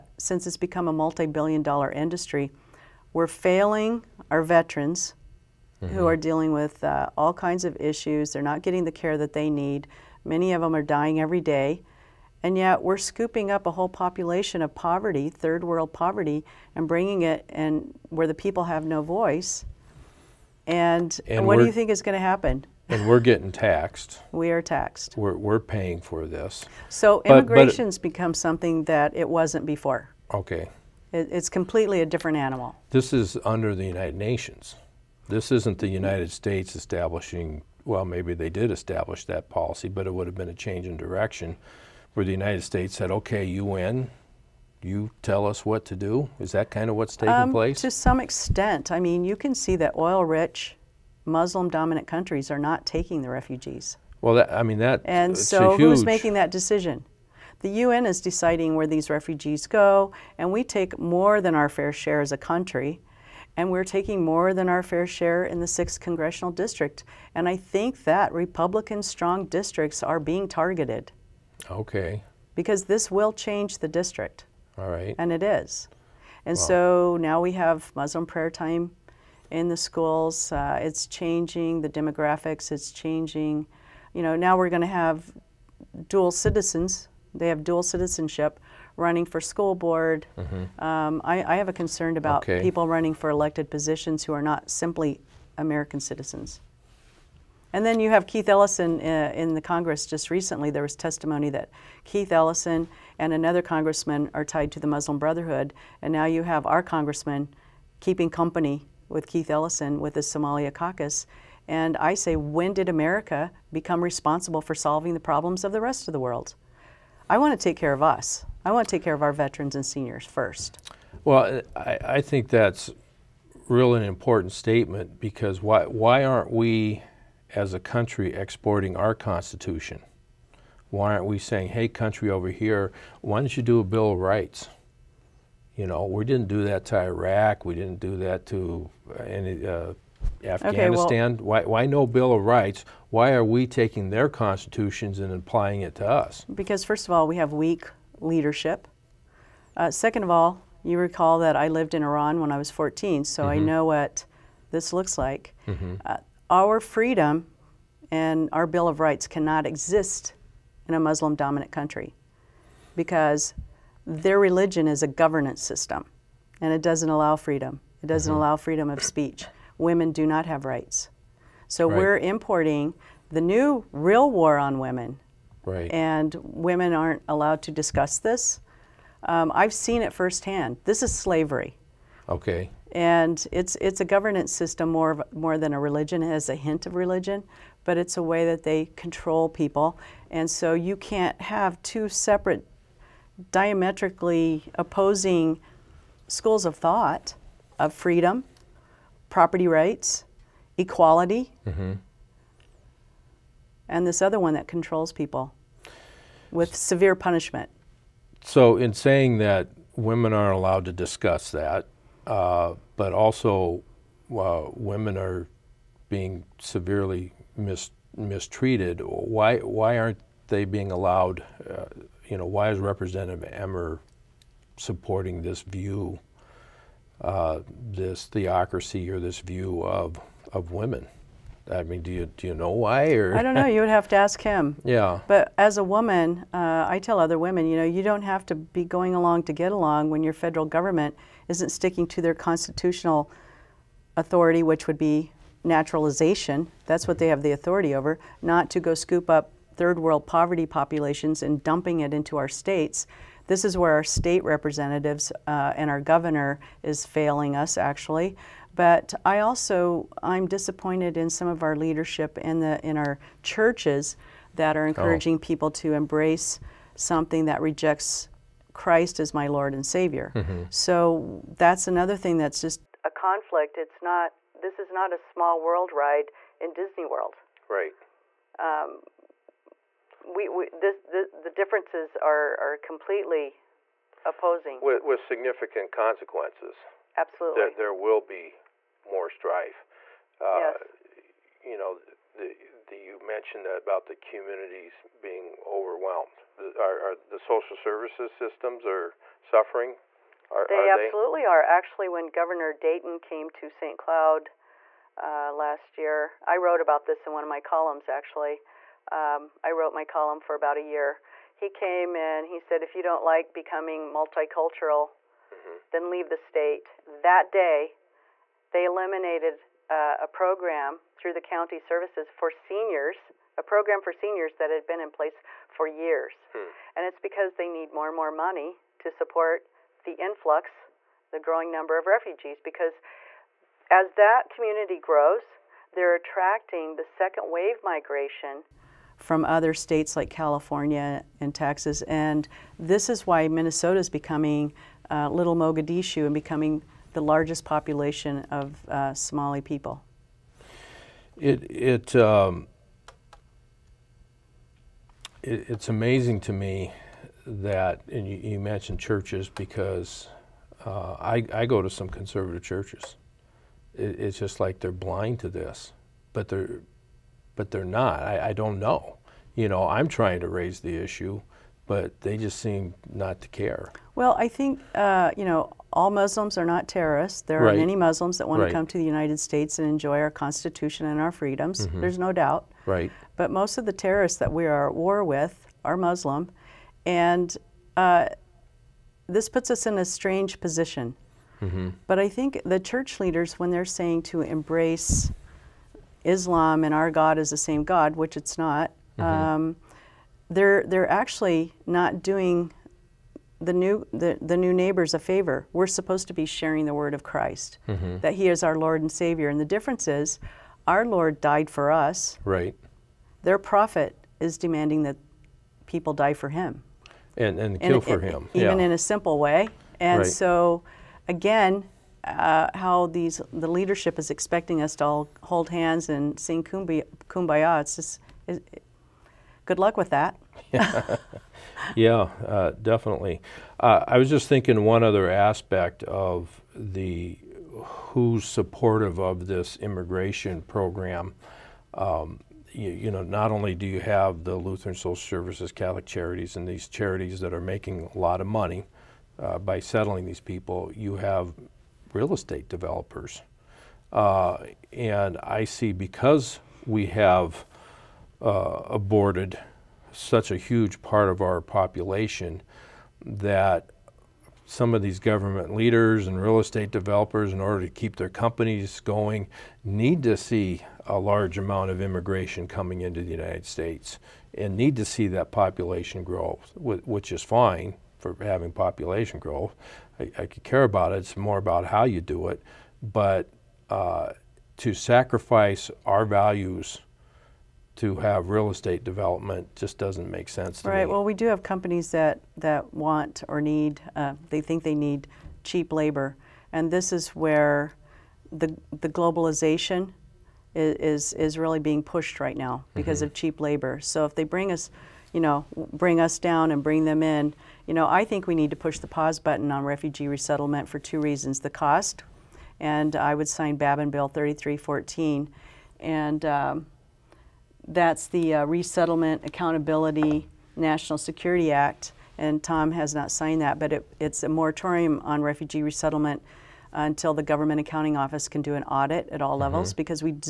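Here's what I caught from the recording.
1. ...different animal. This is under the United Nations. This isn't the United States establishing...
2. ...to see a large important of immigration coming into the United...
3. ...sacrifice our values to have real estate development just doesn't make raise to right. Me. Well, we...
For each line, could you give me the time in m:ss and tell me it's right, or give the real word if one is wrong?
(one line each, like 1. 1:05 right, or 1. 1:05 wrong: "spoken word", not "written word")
1. 0:32 right
2. 7:50 wrong: "amount", not "important"
3. 8:04 wrong: "sense", not "raise".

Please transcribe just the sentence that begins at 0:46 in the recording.
Is that kind of what's taking um, place?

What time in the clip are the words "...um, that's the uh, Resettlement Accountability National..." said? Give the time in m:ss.
8:36.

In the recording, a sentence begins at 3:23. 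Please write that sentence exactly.
and this other one that controls people with severe punishment.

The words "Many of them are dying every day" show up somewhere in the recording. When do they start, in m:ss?
0:10.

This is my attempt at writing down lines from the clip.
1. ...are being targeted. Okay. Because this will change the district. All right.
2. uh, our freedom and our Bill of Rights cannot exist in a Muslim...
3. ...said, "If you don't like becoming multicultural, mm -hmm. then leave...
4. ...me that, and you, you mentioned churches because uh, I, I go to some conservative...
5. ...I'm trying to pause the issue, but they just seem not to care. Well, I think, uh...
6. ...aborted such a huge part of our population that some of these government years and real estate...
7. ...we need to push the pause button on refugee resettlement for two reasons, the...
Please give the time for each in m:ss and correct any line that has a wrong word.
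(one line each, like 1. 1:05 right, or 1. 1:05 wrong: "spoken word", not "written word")
1. 1:10 right
2. 2:36 right
3. 5:12 right
4. 5:56 right
5. 6:09 wrong: "raise", not "pause"
6. 7:38 wrong: "leaders", not "years"
7. 8:28 right.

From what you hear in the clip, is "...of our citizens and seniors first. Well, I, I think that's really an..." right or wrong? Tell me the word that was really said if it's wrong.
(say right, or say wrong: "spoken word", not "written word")
wrong: "veterans", not "citizens".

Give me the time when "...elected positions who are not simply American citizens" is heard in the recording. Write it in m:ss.
1:33.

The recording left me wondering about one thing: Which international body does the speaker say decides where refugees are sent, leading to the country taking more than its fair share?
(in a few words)
The UN.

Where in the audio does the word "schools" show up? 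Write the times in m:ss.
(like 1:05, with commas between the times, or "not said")
1:19, 1:29, 3:16.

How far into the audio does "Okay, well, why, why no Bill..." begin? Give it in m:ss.
2:21.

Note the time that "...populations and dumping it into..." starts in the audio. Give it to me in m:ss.
4:10.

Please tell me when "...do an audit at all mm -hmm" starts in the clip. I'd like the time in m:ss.
8:48.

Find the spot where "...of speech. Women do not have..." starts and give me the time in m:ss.
2:48.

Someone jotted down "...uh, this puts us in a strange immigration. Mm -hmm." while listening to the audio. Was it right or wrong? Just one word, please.
wrong.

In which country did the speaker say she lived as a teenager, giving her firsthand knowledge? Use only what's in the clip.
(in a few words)
Iran.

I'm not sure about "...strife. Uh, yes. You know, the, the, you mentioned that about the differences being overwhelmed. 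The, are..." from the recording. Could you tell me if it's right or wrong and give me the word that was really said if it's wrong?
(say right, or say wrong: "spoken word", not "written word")
wrong: "communities", not "differences".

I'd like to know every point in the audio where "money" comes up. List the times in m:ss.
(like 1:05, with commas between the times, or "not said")
5:28, 7:28.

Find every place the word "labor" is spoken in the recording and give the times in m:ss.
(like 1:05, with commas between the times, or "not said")
8:15, 8:23.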